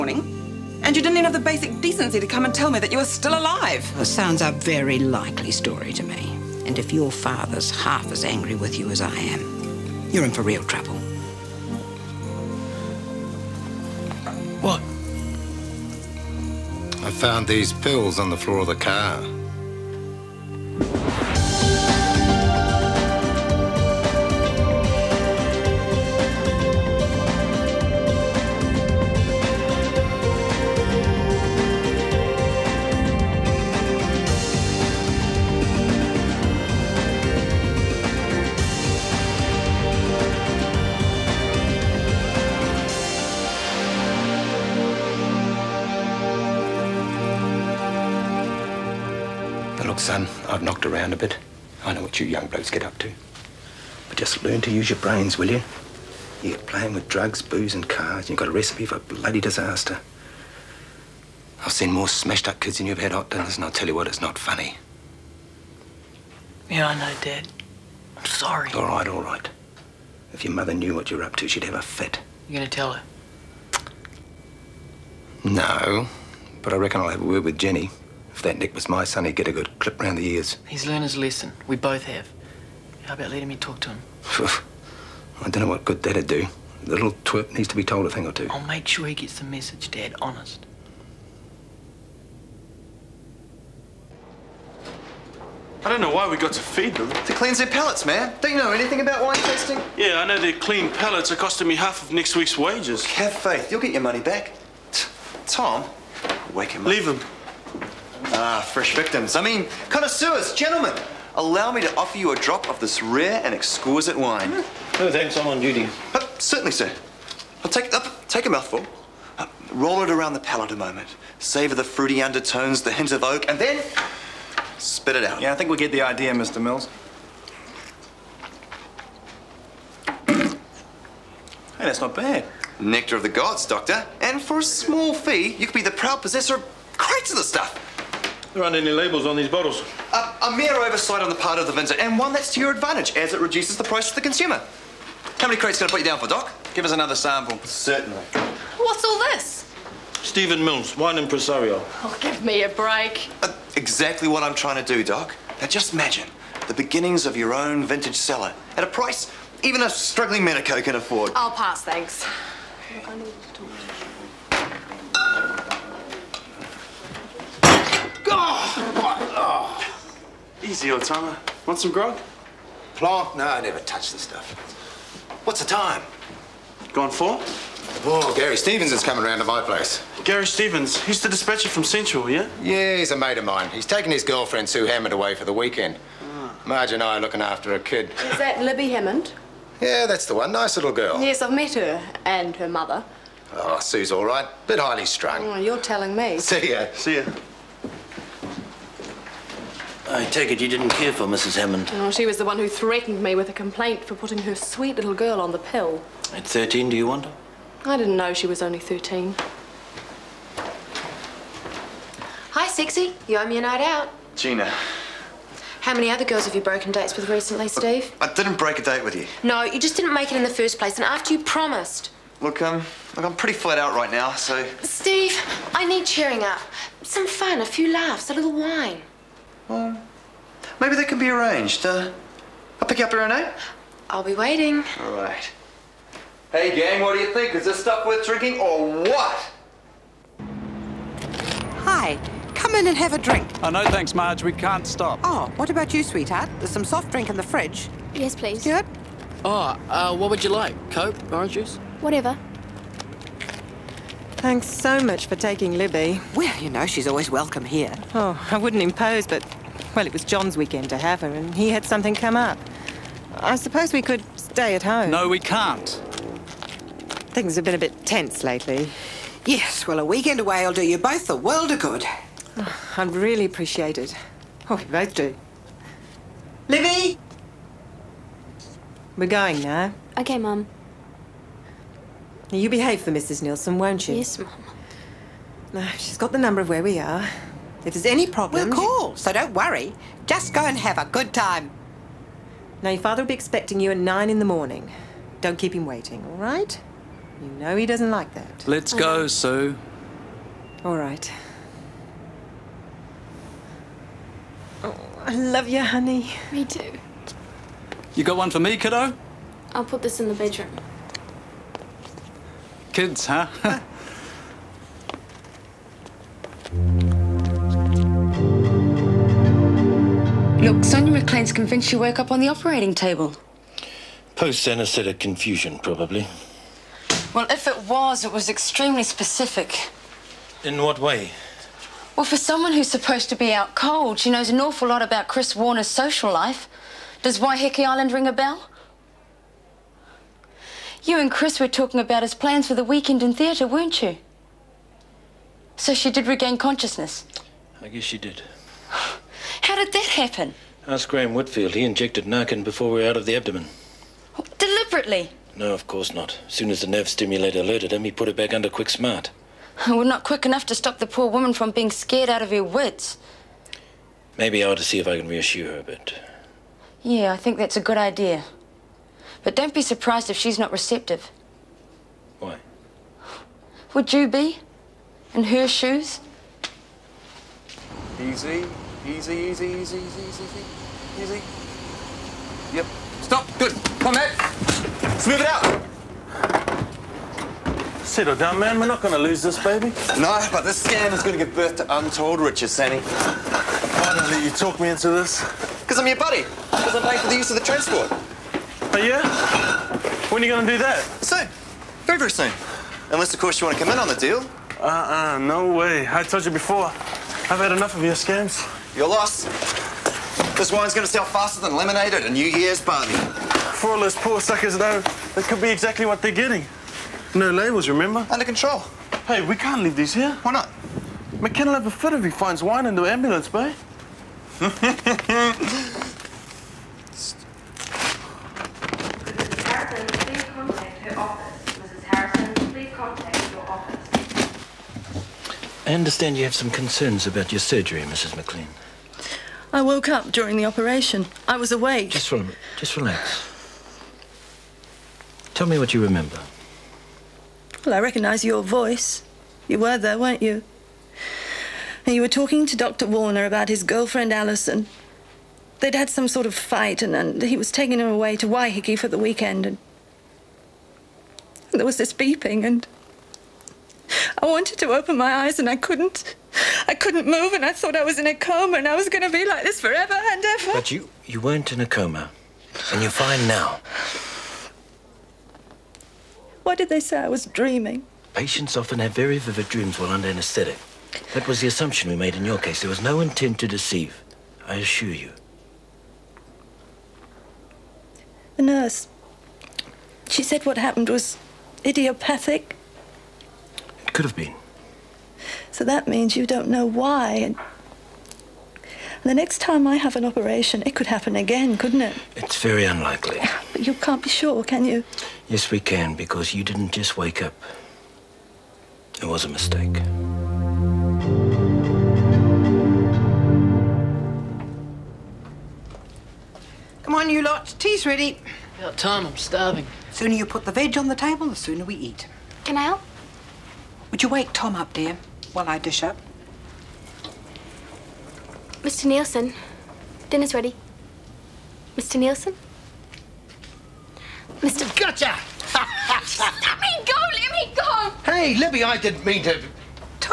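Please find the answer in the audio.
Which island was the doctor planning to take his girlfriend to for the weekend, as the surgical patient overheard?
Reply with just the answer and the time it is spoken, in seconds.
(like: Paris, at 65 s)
Waiheke Island, at 337 s.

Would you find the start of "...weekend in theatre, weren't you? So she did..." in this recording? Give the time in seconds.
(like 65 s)
342 s.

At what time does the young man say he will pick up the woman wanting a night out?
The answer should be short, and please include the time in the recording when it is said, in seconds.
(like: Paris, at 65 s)
8, at 233 s.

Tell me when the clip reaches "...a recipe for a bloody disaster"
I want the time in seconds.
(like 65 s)
58 s.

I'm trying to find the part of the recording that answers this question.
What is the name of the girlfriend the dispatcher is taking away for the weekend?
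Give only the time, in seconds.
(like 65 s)
184 s.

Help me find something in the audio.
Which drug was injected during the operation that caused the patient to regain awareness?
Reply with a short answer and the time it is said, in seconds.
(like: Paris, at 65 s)
Narcan, at 352 s.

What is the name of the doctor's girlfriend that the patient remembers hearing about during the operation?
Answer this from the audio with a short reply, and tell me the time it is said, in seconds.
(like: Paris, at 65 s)
Alison, at 454 s.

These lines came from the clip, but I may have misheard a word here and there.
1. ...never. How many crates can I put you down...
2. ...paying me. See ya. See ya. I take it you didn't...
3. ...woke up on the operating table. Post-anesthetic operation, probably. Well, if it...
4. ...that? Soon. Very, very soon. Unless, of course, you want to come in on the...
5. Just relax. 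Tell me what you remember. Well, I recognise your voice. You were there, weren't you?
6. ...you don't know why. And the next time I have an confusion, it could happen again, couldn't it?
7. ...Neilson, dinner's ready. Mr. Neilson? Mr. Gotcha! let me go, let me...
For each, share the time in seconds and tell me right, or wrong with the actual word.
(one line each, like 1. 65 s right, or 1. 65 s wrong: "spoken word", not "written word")
1. 144 s wrong: "consumer", not "never"
2. 195 s wrong: "telling", not "paying"
3. 321 s wrong: "confusion", not "operation"
4. 400 s right
5. 442 s right
6. 496 s wrong: "operation", not "confusion"
7. 529 s right.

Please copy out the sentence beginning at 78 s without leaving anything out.
If that Nick was my son, he'd get a good clip round the ears.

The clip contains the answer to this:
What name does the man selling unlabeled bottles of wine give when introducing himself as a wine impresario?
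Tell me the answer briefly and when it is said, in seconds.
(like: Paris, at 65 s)
Stephen Mills, at 150 s.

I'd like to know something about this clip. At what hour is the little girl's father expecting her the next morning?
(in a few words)
9.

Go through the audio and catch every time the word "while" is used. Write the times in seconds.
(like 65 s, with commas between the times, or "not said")
479 s, 525 s.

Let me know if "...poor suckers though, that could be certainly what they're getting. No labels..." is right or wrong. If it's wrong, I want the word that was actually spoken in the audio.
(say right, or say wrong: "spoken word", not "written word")
wrong: "exactly", not "certainly".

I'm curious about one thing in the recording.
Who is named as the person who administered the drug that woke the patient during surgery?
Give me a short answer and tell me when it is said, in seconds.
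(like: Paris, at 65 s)
Graham Whitfield, at 351 s.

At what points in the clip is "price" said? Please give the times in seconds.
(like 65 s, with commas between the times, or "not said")
143 s, 158 s.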